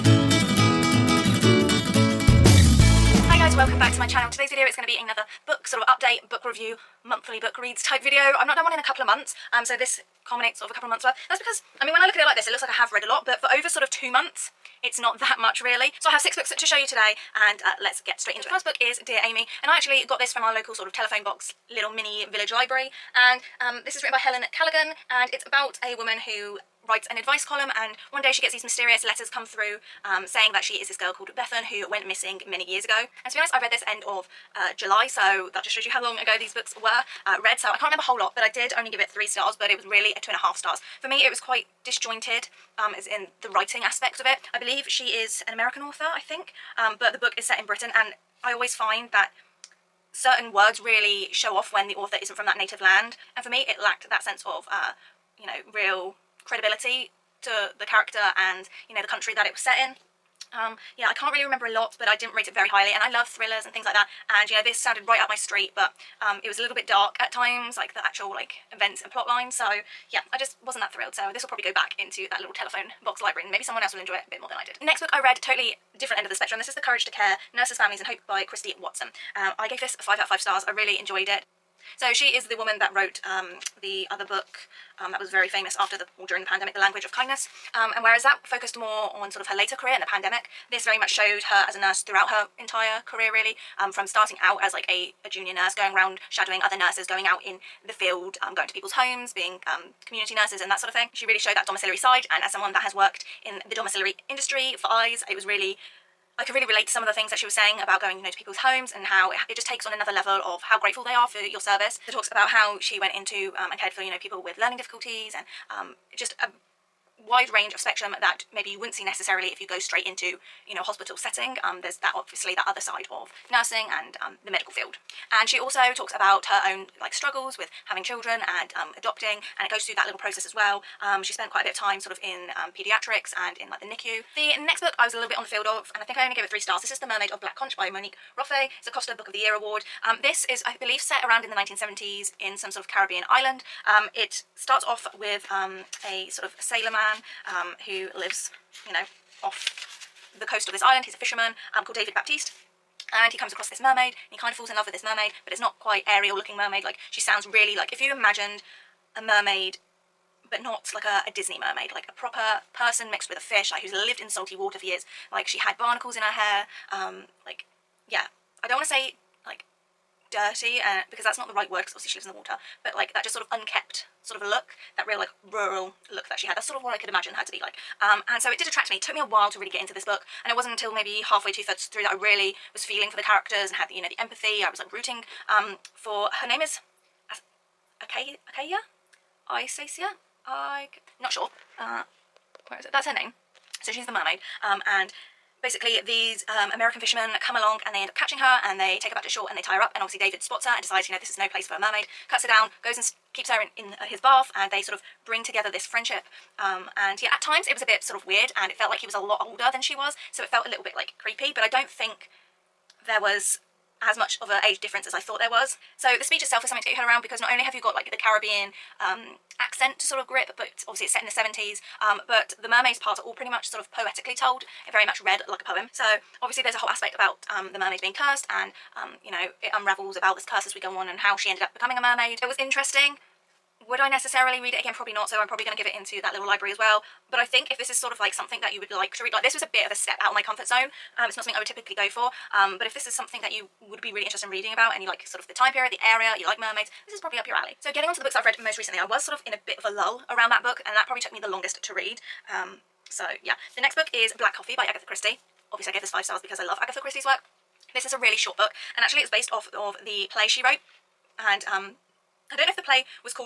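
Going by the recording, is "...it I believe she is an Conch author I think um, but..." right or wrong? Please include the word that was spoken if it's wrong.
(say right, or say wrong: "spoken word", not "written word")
wrong: "American", not "Conch".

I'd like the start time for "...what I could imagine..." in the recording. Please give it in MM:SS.
02:56.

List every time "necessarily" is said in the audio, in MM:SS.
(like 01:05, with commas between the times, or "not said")
01:59, 03:54.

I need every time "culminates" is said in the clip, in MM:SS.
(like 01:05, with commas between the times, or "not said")
00:10.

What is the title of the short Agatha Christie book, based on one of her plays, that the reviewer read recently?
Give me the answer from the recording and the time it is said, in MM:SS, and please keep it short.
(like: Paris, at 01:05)
Black Coffee, at 04:14.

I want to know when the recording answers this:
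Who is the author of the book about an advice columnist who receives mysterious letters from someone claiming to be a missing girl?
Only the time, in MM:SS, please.
00:24.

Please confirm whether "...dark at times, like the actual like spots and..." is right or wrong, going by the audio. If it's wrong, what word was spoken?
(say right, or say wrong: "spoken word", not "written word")
wrong: "events", not "spots".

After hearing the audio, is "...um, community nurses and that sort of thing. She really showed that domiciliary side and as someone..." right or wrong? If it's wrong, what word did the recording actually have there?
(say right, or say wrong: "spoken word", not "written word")
right.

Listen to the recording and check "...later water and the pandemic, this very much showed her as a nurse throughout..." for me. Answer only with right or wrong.
wrong.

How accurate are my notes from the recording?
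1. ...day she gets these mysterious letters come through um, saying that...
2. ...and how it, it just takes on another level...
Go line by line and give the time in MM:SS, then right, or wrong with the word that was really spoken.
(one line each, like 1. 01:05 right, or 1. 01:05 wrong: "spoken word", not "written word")
1. 00:28 right
2. 01:48 right.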